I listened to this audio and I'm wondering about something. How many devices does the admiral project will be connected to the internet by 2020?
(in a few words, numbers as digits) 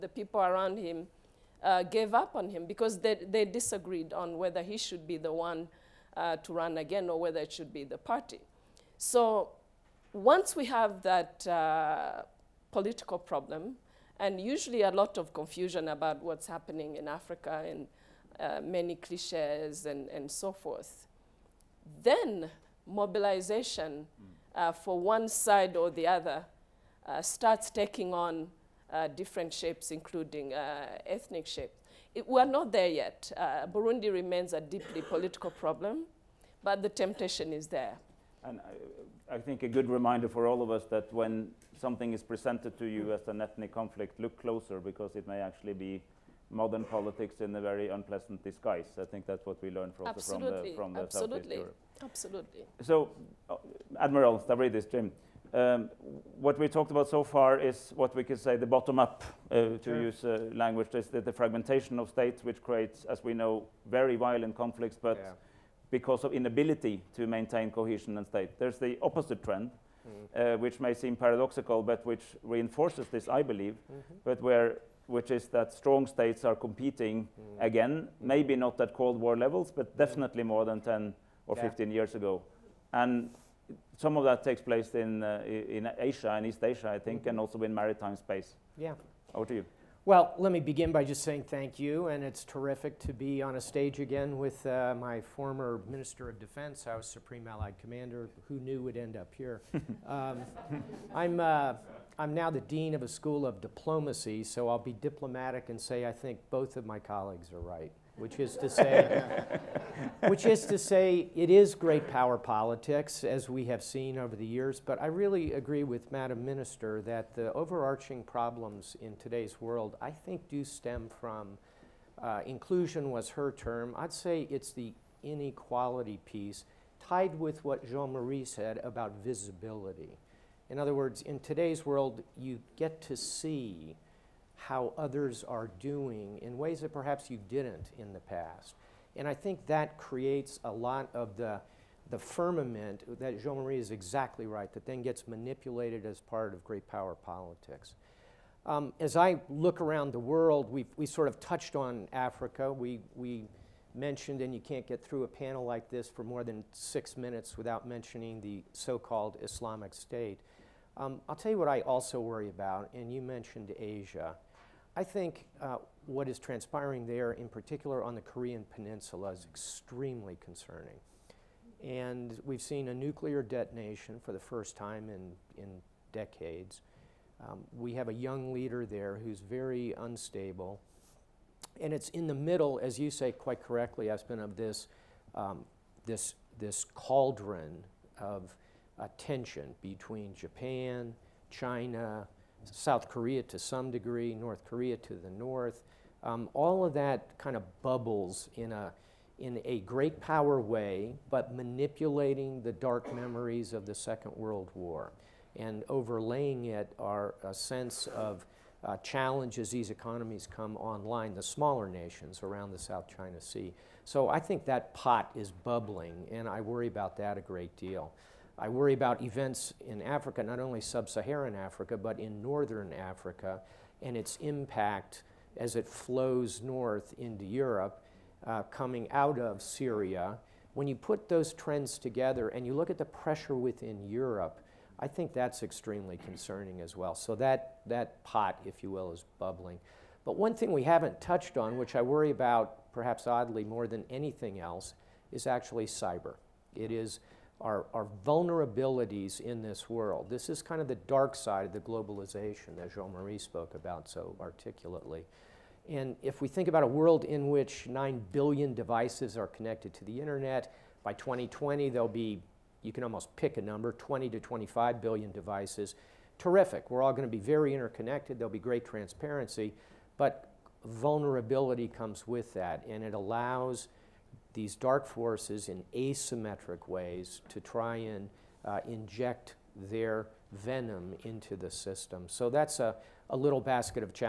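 20 to 25 billion.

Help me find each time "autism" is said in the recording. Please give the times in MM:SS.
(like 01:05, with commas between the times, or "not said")
not said.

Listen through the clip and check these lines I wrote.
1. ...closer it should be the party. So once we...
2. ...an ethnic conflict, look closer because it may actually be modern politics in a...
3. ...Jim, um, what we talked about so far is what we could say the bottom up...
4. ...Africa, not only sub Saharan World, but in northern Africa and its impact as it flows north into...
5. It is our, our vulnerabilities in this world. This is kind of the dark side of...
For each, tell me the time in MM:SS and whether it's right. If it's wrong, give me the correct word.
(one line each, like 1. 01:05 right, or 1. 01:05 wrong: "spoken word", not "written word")
1. 00:07 wrong: "whether", not "closer"
2. 00:43 right
3. 00:54 right
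4. 03:40 wrong: "Africa", not "World"
5. 04:06 right.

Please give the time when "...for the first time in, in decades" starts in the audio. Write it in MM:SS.
02:54.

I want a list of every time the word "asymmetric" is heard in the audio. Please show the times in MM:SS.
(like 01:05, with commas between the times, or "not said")
04:35.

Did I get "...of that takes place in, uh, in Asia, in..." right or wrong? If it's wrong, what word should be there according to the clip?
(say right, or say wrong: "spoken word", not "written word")
right.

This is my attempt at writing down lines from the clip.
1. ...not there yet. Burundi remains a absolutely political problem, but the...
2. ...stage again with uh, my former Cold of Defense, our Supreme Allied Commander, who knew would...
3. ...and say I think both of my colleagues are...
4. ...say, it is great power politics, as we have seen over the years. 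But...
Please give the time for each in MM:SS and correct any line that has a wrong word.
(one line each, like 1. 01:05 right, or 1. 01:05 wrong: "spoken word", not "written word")
1. 00:32 wrong: "deeply", not "absolutely"
2. 01:33 wrong: "Minister", not "Cold"
3. 01:45 right
4. 01:50 right.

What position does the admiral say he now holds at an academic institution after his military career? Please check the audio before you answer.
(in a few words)
Dean of a School of Diplomacy.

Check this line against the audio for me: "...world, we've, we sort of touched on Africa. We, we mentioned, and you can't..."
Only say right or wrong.
right.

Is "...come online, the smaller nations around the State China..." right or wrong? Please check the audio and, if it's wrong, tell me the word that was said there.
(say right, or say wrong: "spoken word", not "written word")
wrong: "South", not "State".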